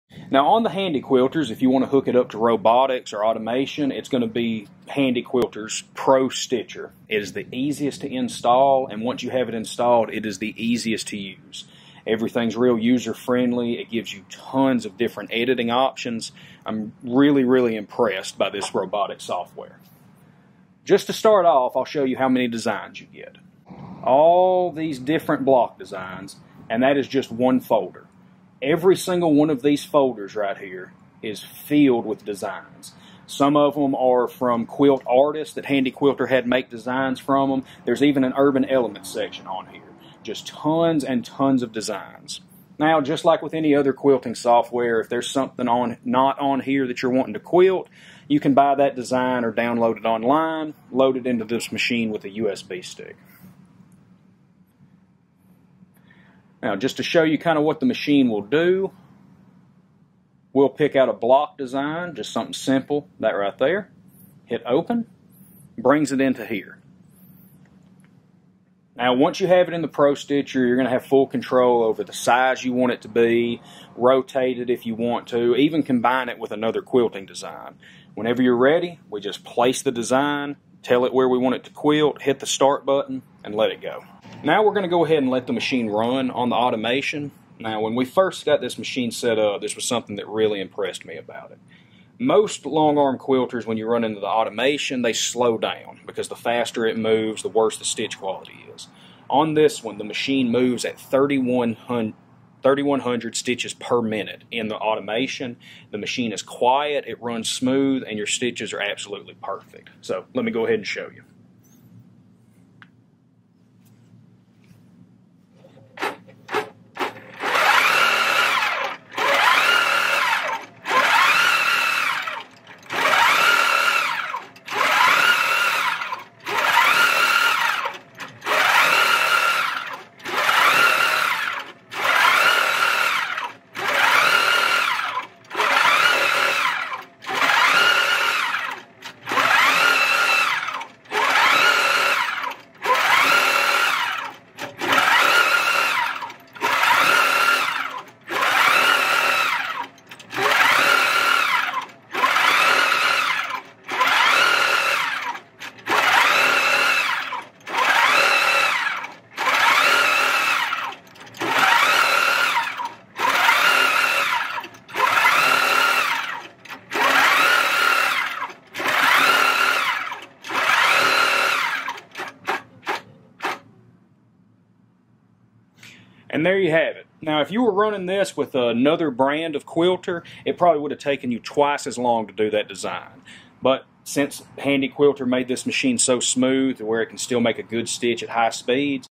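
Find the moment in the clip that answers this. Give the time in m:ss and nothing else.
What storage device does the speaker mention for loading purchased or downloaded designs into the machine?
0:52.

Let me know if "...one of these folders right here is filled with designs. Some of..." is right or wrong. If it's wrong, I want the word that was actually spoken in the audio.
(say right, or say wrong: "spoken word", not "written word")
right.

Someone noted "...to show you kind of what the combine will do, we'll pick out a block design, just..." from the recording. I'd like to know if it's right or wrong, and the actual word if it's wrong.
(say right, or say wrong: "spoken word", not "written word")
wrong: "machine", not "combine".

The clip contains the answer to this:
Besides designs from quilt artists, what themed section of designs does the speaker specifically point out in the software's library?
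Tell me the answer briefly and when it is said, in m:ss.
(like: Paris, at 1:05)
urban element, at 0:38.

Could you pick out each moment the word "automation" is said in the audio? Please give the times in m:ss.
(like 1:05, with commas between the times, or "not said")
0:03, 1:26, 1:34, 1:44.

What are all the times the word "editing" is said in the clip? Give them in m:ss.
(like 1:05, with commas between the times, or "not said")
0:15.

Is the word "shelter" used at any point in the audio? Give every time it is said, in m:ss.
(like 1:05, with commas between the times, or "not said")
not said.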